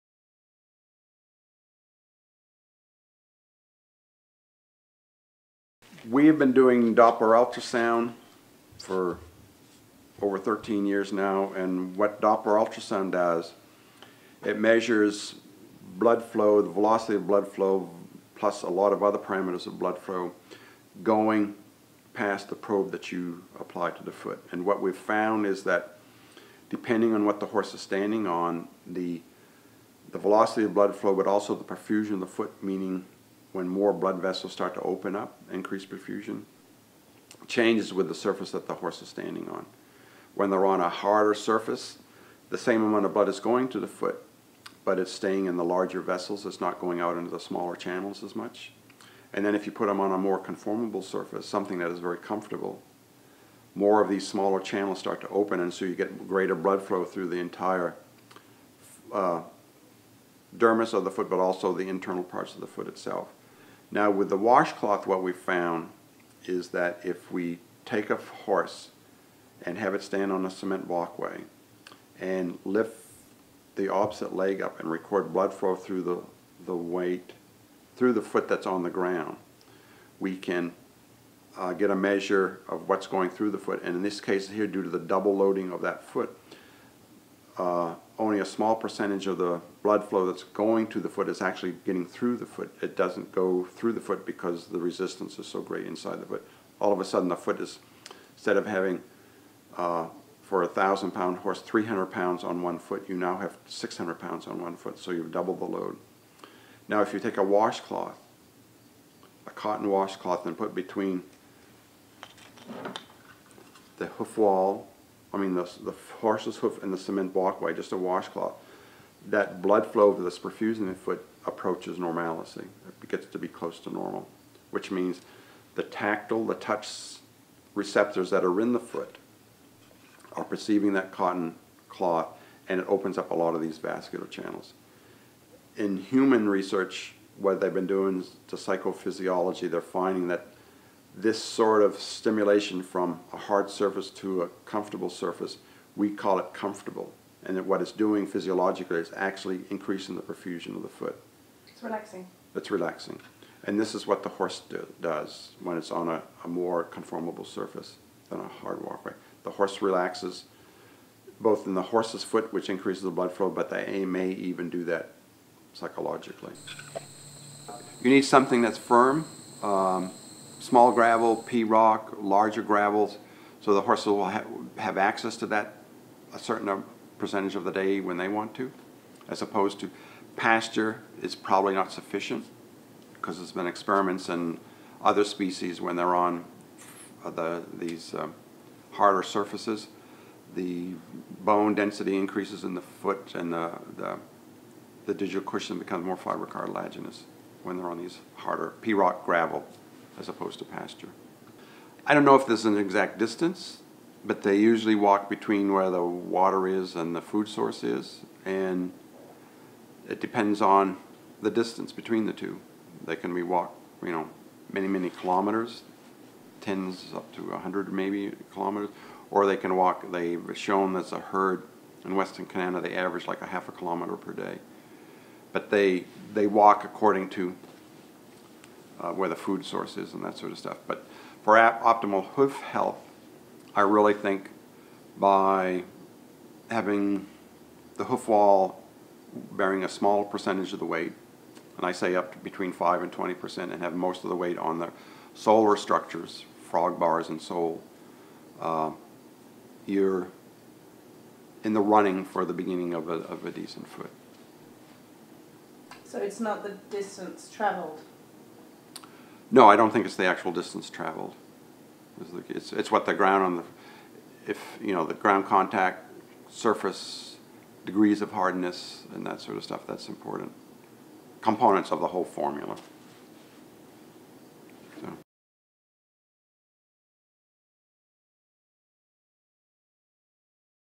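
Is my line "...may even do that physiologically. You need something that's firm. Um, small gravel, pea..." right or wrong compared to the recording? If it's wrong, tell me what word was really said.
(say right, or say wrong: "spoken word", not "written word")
wrong: "psychologically", not "physiologically".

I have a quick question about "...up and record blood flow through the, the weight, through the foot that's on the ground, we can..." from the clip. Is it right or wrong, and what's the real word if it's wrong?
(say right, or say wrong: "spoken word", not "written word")
right.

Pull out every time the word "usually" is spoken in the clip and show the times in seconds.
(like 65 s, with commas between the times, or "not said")
204 s.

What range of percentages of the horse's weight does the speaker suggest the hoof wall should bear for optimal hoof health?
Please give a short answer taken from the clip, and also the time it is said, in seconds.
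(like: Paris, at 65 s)
5 to 20 percent, at 242 s.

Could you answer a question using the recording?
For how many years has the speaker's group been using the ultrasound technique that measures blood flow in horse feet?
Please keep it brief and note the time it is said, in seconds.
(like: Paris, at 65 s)
13 years, at 10 s.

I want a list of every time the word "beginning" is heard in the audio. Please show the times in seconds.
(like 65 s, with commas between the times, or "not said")
252 s.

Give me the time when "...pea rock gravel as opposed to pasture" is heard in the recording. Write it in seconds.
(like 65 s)
198 s.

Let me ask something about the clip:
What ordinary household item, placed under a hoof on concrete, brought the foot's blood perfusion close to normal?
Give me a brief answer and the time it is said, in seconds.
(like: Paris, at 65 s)
a cotton washcloth, at 109 s.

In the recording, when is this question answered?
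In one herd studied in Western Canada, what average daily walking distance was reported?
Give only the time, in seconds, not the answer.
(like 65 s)
223 s.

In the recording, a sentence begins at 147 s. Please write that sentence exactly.
And that what it's doing physiologically is actually increasing the perfusion of the foot.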